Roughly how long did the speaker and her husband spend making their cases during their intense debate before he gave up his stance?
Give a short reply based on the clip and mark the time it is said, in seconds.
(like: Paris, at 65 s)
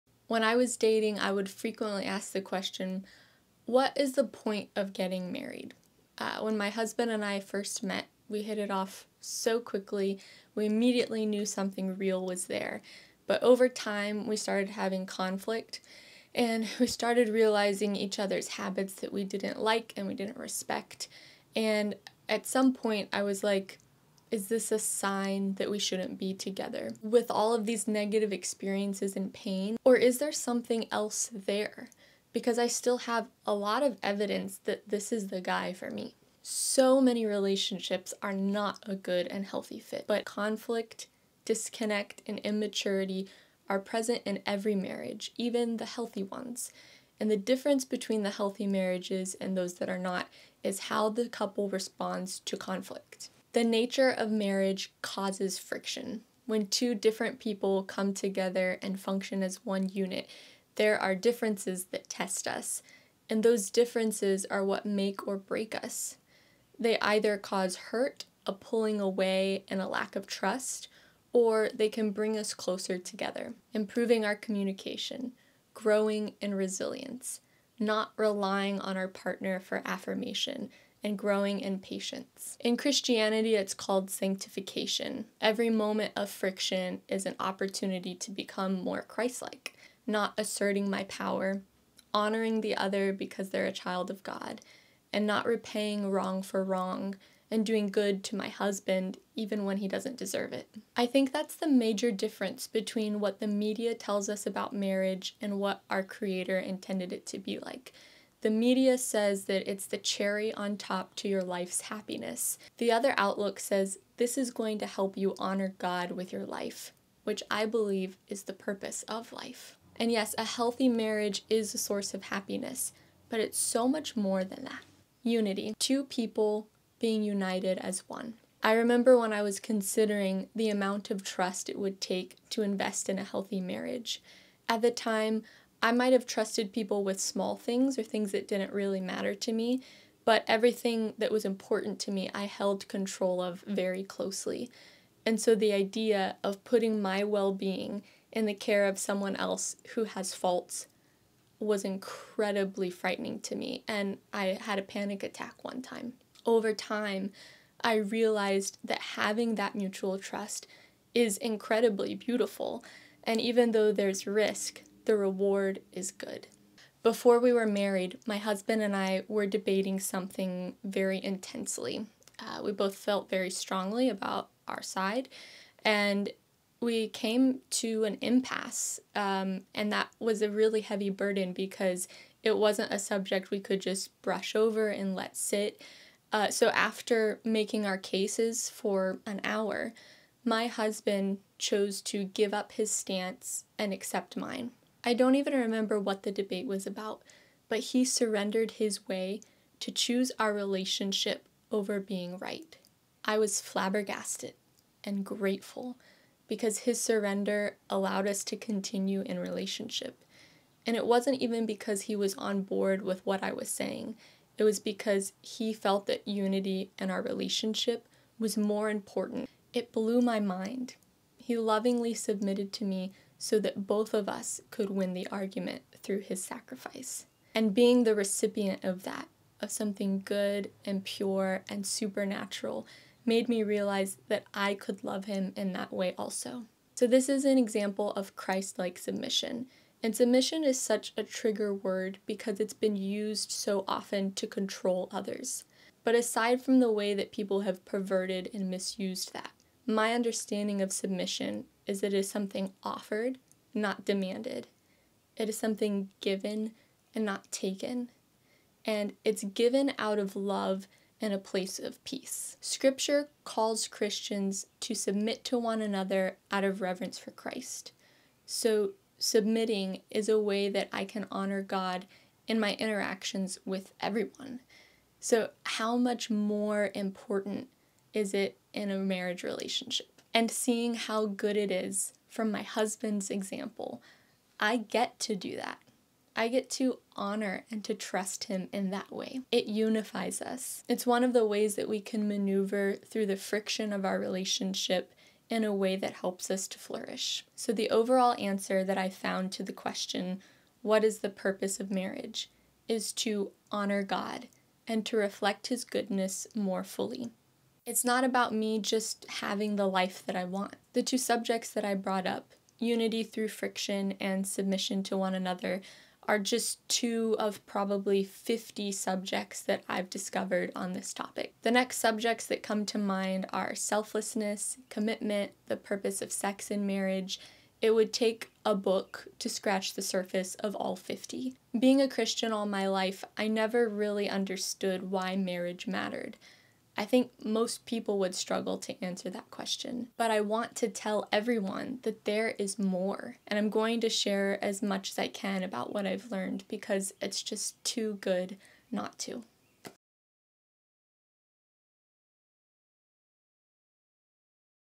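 an hour, at 189 s.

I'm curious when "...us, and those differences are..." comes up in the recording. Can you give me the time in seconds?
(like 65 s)
62 s.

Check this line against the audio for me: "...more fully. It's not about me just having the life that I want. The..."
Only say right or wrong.
right.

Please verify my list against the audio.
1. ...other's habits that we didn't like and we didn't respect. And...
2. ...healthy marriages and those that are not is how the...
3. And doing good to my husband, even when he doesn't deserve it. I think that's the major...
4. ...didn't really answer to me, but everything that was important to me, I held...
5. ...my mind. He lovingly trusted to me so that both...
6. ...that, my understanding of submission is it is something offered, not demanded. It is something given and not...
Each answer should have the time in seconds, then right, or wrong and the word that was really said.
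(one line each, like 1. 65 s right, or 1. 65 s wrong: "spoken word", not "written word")
1. 18 s right
2. 48 s right
3. 97 s right
4. 138 s wrong: "matter", not "answer"
5. 220 s wrong: "submitted", not "trusted"
6. 249 s right.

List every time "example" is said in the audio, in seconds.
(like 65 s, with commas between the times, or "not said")
237 s, 283 s.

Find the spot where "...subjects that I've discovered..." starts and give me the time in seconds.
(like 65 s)
318 s.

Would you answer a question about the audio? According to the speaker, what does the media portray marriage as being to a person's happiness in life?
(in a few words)
the cherry on top.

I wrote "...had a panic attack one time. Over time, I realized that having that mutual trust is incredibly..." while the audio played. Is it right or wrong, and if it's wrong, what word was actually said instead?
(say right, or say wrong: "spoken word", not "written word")
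right.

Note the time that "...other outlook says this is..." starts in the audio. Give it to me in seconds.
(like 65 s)
112 s.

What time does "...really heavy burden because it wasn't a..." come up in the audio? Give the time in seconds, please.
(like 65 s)
180 s.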